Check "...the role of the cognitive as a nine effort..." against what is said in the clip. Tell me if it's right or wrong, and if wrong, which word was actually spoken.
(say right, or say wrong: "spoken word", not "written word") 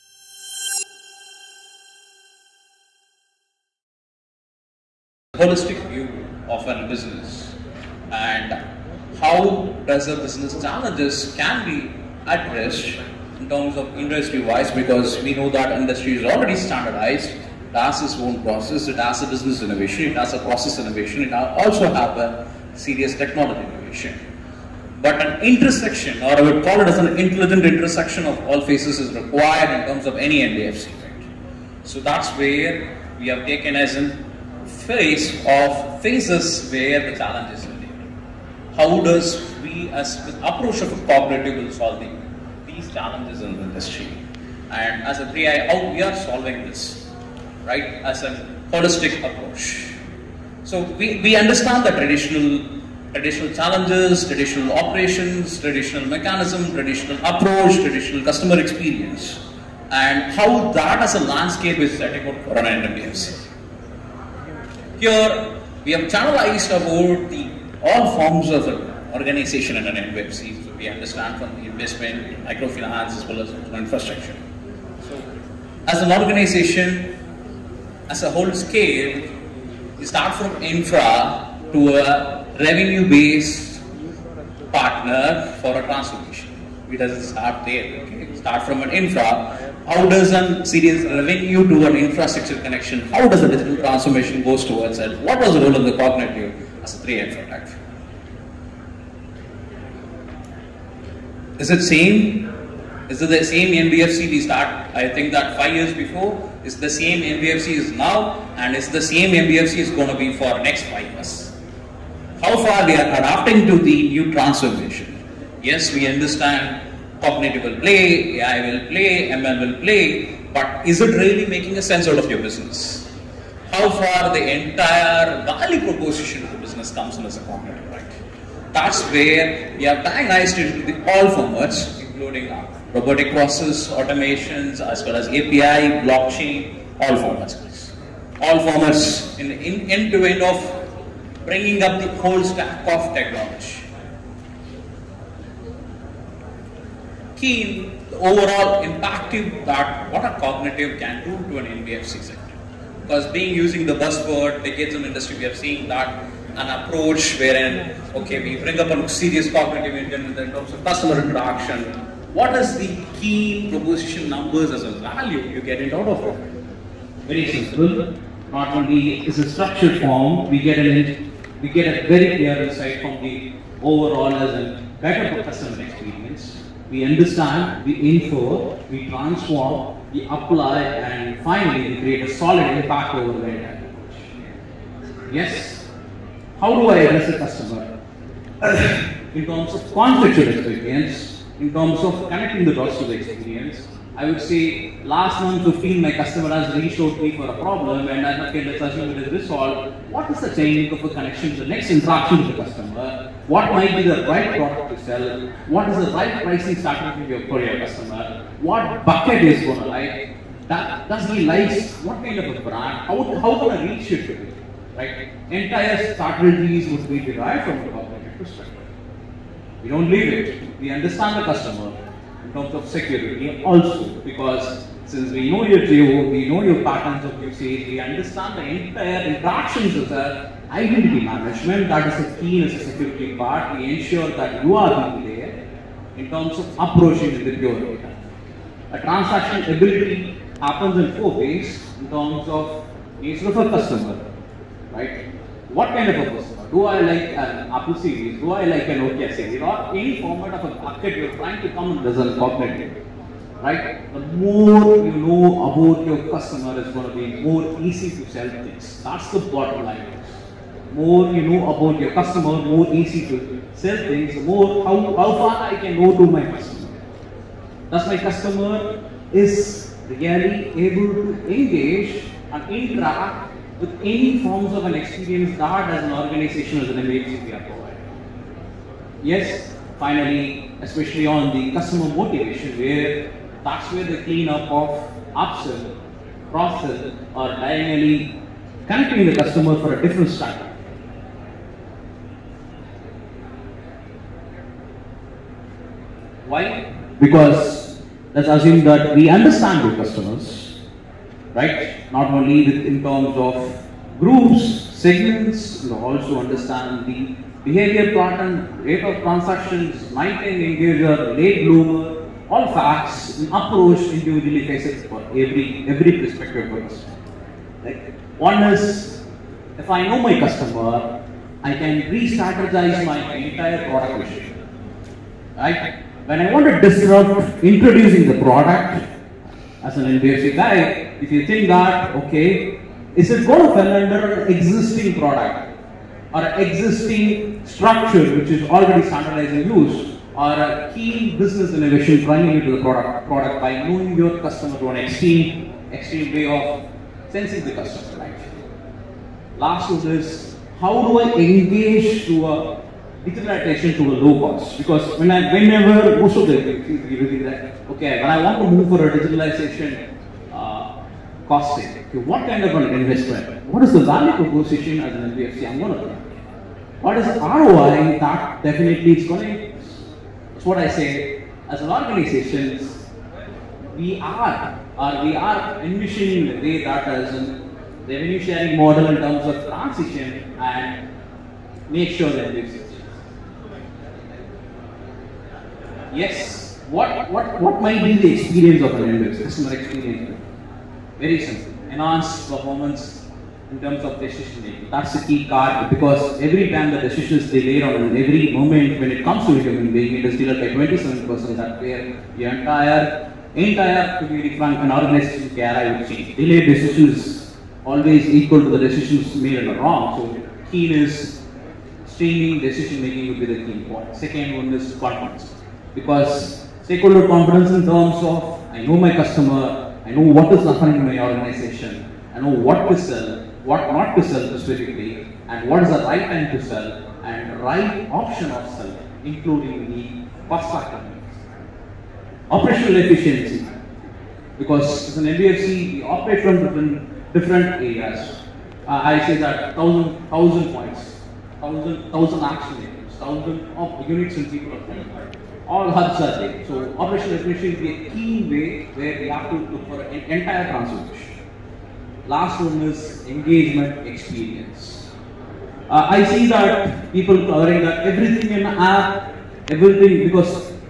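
wrong: "three", not "nine".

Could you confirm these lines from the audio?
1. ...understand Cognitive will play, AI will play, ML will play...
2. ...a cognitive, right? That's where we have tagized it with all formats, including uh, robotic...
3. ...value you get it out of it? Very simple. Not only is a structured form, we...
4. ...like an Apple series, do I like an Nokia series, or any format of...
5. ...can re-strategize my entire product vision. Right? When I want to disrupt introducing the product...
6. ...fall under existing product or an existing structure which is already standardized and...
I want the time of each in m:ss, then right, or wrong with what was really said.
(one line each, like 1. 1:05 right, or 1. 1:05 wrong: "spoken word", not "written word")
1. 1:56 right
2. 2:07 right
3. 2:45 right
4. 4:07 right
5. 5:21 right
6. 5:33 right.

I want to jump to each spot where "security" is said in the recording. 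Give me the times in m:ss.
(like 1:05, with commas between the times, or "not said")
3:42, 3:52.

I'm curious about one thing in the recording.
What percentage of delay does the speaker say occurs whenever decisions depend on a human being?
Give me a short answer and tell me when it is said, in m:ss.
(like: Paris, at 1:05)
27%, at 6:40.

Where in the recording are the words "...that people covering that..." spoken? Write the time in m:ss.
7:36.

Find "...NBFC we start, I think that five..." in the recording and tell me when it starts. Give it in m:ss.
1:43.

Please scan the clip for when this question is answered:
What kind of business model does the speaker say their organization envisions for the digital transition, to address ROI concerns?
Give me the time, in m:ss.
6:18.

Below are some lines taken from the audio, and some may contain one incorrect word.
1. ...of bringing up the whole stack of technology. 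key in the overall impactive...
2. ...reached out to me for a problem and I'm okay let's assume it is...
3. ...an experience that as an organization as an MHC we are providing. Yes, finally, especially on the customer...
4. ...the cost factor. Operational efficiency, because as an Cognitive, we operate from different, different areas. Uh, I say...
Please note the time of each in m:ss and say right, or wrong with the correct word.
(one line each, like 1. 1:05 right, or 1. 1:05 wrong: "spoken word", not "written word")
1. 2:20 right
2. 3:16 right
3. 4:34 right
4. 7:10 wrong: "NBFC", not "Cognitive".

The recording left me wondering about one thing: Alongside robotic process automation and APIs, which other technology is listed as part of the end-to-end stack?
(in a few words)
Blockchain.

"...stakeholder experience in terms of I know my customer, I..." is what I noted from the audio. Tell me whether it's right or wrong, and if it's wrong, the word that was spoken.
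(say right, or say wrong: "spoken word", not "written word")
wrong: "confidence", not "experience".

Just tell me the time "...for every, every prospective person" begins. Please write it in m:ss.
5:15.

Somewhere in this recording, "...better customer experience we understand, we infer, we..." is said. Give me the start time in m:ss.
2:55.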